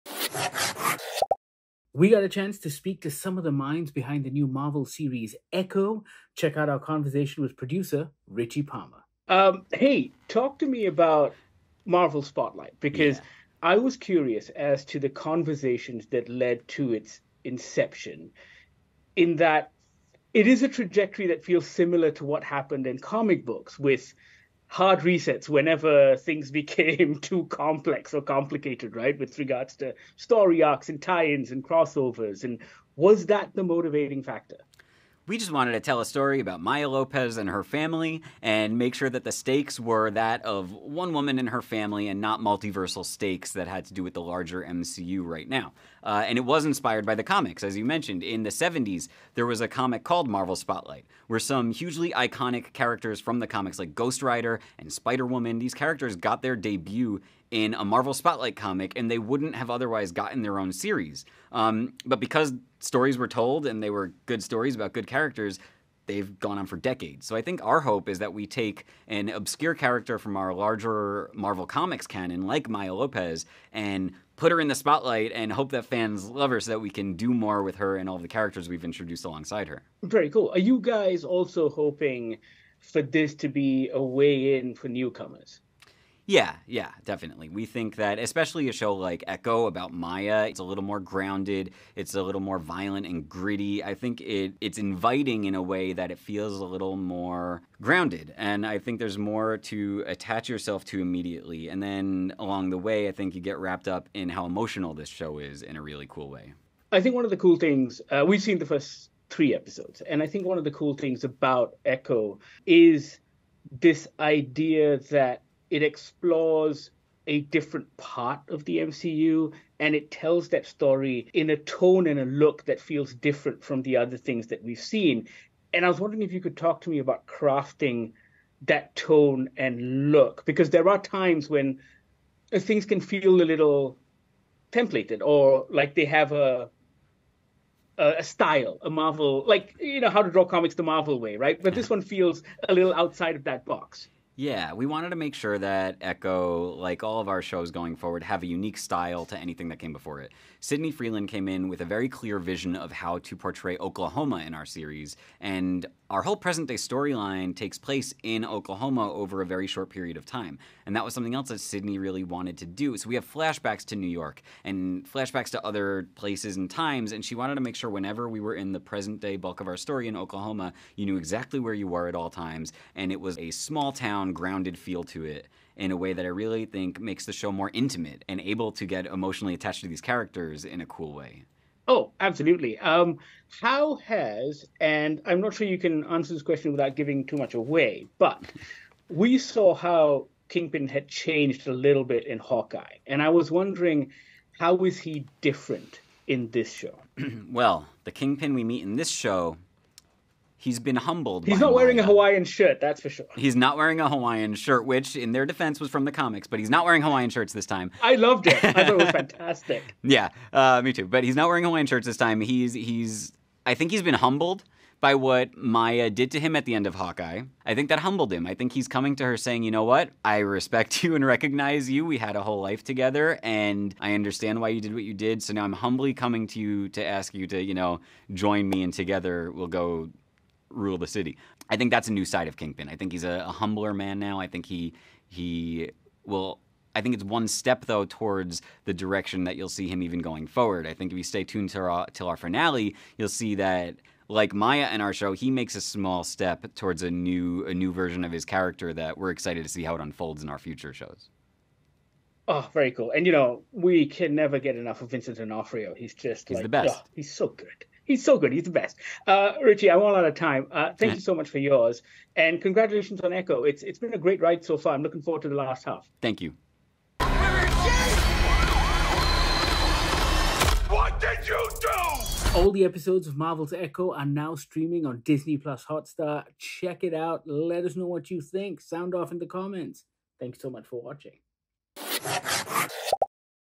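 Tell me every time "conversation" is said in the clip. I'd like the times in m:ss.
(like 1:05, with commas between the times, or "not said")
0:06, 0:15.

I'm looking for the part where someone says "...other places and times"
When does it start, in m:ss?
2:45.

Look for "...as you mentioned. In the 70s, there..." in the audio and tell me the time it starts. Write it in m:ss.
0:47.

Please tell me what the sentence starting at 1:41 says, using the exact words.
And then along the way, I think you get wrapped up in how emotional this show is in a really cool way.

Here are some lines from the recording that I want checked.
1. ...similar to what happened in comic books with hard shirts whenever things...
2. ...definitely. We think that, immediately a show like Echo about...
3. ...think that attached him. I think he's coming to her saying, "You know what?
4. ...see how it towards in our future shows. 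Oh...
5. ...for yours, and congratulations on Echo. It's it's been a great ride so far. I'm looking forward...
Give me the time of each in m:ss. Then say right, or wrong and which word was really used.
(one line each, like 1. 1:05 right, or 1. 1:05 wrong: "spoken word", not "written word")
1. 0:21 wrong: "resets", not "shirts"
2. 1:27 wrong: "especially", not "immediately"
3. 3:37 wrong: "humbled", not "attached"
4. 4:09 wrong: "unfolds", not "towards"
5. 4:21 right.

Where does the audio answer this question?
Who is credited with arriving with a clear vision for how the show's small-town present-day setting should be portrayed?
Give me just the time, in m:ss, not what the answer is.
2:30.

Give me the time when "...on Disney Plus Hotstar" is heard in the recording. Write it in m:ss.
4:35.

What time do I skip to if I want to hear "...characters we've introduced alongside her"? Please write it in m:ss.
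1:18.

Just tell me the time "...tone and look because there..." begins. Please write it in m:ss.
2:08.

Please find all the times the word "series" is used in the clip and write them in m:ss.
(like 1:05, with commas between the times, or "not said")
0:04, 1:00, 2:34.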